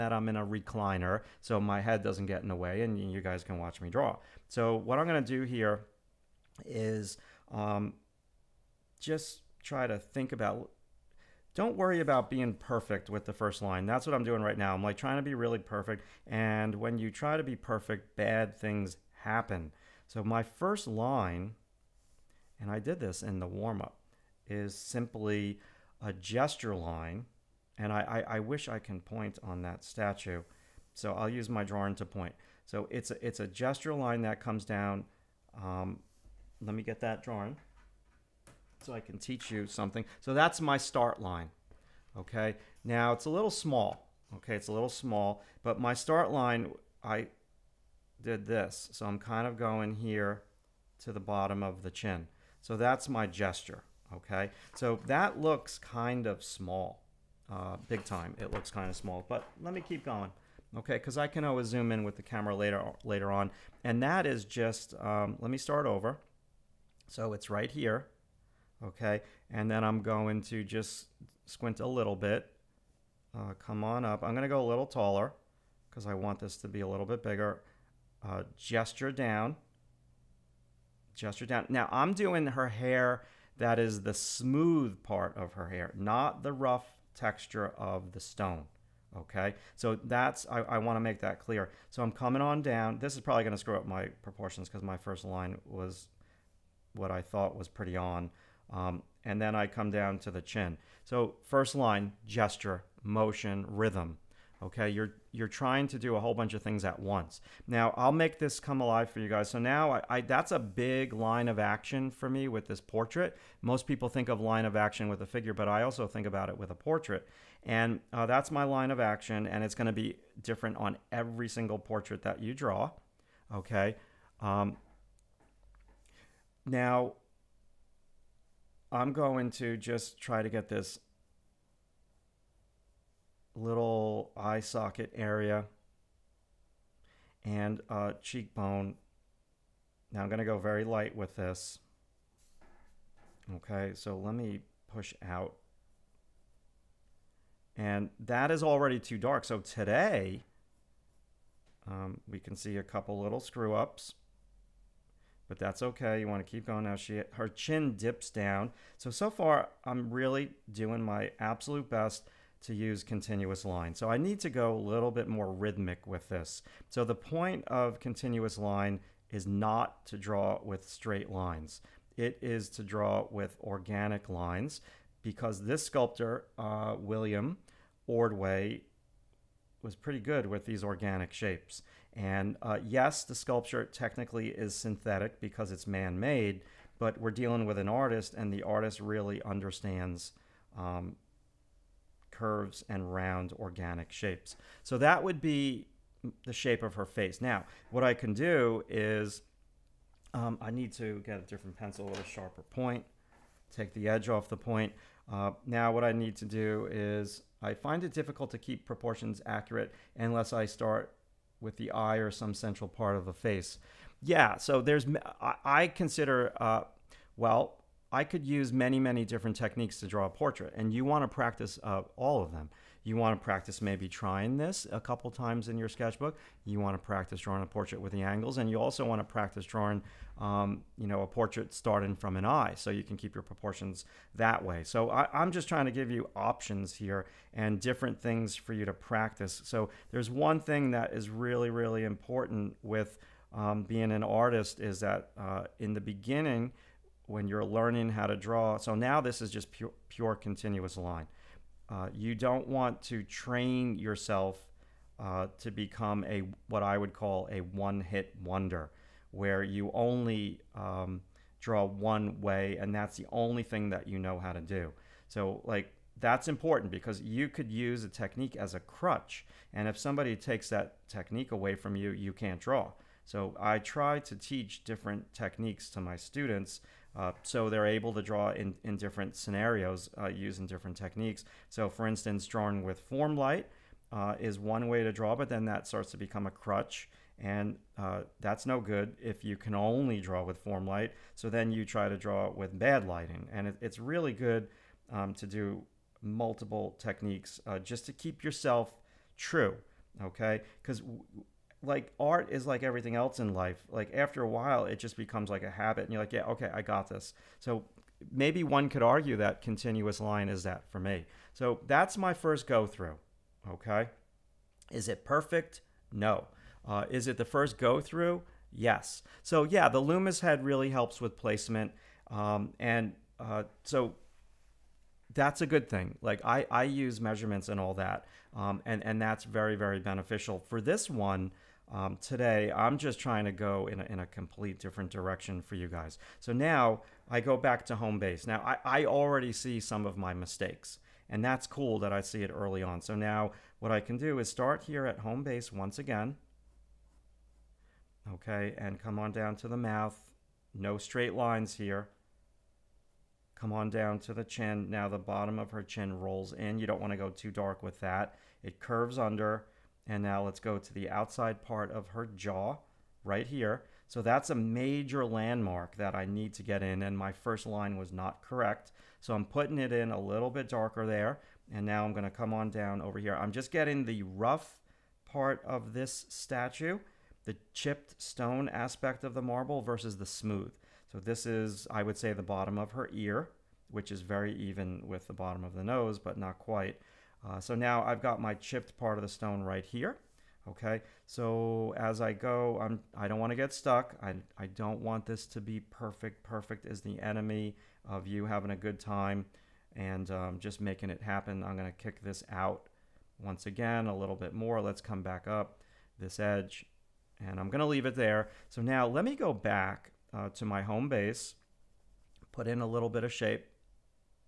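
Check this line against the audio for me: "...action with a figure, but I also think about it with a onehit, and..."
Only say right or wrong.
wrong.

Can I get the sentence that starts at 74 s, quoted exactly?
I'm gonna go a little taller because I want this to be a little bit bigger.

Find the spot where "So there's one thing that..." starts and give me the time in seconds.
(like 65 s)
239 s.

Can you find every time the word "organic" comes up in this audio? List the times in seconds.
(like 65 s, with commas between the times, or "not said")
173 s, 180 s, 193 s.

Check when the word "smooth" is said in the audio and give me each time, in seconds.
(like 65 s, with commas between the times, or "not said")
84 s, 380 s.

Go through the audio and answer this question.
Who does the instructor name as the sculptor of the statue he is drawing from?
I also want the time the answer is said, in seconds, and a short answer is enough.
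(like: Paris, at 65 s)
William Ordway, at 176 s.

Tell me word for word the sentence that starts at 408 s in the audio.
So now let me go back uh, to my home base, put in a little bit of shape.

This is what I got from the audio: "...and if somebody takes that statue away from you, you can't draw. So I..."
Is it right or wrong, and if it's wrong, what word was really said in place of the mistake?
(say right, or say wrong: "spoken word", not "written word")
wrong: "technique", not "statue".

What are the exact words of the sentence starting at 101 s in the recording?
So first line, gesture, motion, rhythm.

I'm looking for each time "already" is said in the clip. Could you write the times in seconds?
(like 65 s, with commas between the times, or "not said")
148 s, 339 s.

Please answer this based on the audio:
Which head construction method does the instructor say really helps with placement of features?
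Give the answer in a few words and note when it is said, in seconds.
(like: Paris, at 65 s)
Loomis head, at 319 s.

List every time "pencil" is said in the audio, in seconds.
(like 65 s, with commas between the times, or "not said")
201 s.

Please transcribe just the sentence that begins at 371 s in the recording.
And now I'm gonna come on down over here.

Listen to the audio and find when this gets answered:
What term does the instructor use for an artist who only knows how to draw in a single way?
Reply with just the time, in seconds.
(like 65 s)
257 s.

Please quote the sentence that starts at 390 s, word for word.
Okay, so as I go, I'm, I don't want to get stuck.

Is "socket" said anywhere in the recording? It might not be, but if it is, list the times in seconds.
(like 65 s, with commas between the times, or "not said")
134 s.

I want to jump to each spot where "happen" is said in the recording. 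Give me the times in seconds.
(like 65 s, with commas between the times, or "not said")
19 s, 401 s.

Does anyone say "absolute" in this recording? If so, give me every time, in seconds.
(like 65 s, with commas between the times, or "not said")
161 s.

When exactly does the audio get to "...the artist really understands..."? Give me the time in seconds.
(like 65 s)
188 s.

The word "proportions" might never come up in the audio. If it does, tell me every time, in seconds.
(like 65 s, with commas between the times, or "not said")
94 s, 208 s, 233 s.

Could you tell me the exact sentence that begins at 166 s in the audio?
So the point of continuous line is not to draw with straight lines.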